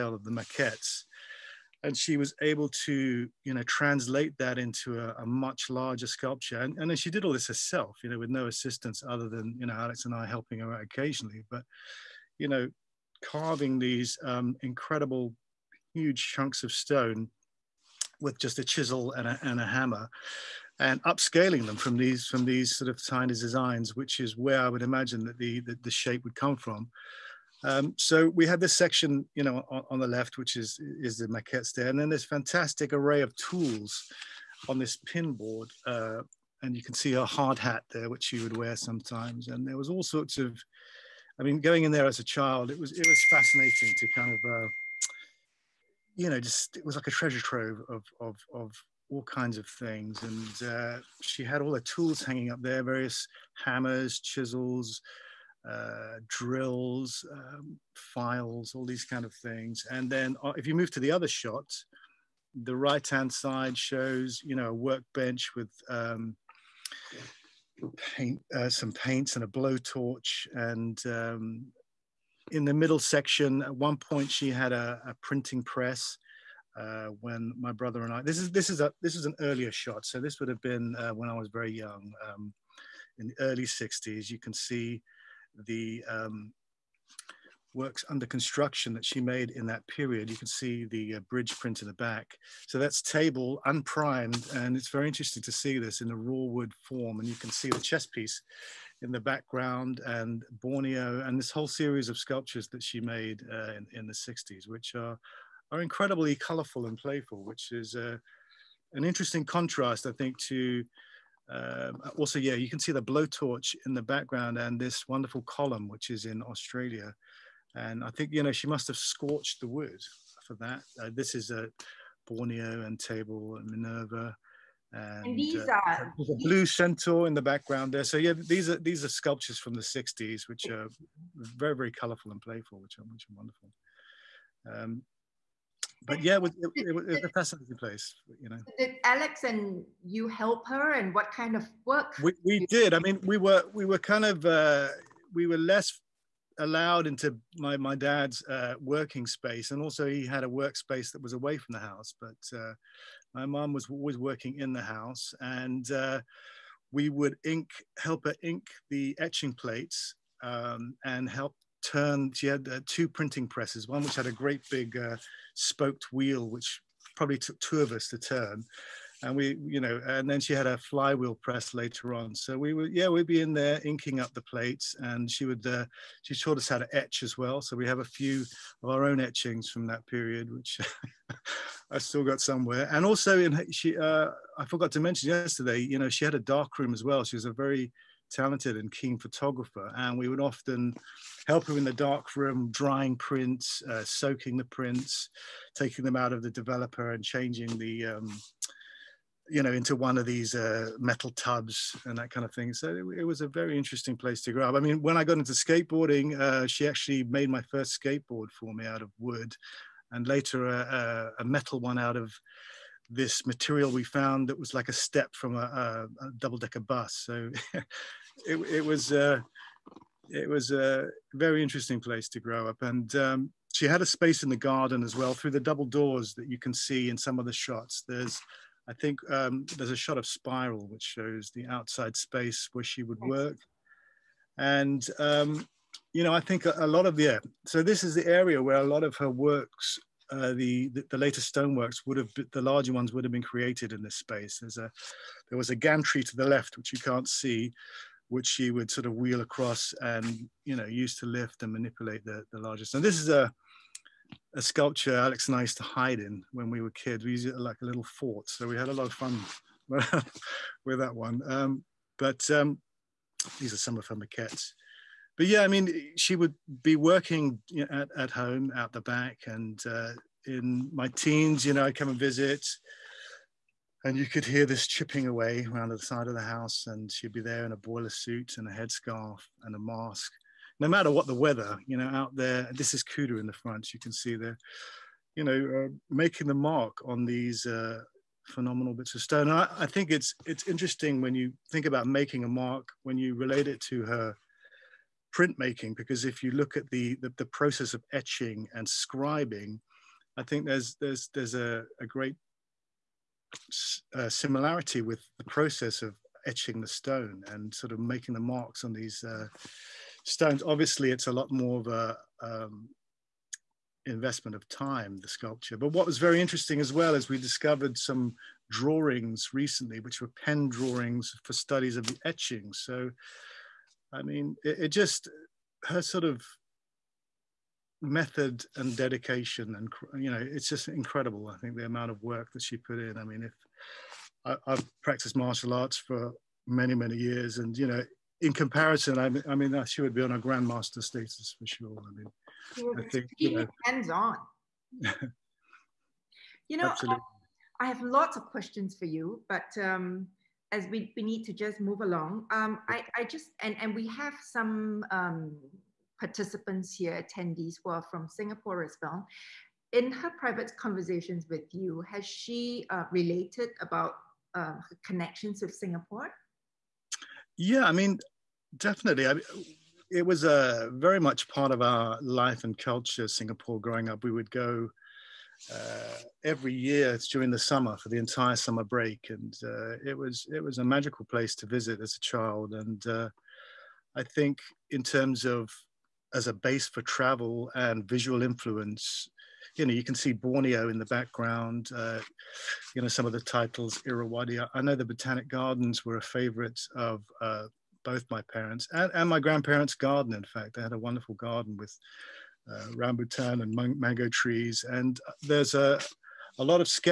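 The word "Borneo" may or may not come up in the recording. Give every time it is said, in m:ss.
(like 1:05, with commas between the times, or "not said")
1:40, 2:02, 6:30.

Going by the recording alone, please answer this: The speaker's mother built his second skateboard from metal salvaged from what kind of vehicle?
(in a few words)
double decker bus.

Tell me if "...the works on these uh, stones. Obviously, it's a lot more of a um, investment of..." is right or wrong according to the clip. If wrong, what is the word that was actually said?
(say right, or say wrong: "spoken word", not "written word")
wrong: "marks", not "works".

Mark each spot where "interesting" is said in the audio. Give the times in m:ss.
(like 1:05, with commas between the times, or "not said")
1:35, 1:49, 3:23, 3:41, 4:50, 5:16.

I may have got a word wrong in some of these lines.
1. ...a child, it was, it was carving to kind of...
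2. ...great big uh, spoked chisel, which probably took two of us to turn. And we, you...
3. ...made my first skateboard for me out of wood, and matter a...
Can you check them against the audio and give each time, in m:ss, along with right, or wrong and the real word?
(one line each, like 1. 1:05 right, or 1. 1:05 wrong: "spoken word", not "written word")
1. 0:42 wrong: "fascinating", not "carving"
2. 2:44 wrong: "wheel", not "chisel"
3. 3:27 wrong: "later", not "matter".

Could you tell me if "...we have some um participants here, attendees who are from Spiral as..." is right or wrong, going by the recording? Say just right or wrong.
wrong.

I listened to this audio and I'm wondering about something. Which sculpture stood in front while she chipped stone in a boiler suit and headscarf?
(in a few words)
Kudu.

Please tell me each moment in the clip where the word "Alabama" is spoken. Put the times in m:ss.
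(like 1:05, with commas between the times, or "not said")
not said.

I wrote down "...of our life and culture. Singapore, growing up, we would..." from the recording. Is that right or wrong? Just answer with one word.
right.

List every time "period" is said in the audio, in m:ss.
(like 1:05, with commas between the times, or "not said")
1:29, 3:00.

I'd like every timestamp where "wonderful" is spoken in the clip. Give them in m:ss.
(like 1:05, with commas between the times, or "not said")
1:55, 2:13, 6:40.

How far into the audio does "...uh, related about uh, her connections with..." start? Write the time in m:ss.
6:02.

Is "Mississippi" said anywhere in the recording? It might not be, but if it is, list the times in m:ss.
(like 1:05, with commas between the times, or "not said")
not said.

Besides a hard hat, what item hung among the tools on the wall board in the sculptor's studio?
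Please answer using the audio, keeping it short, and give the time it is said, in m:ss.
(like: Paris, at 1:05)
pin board, at 0:34.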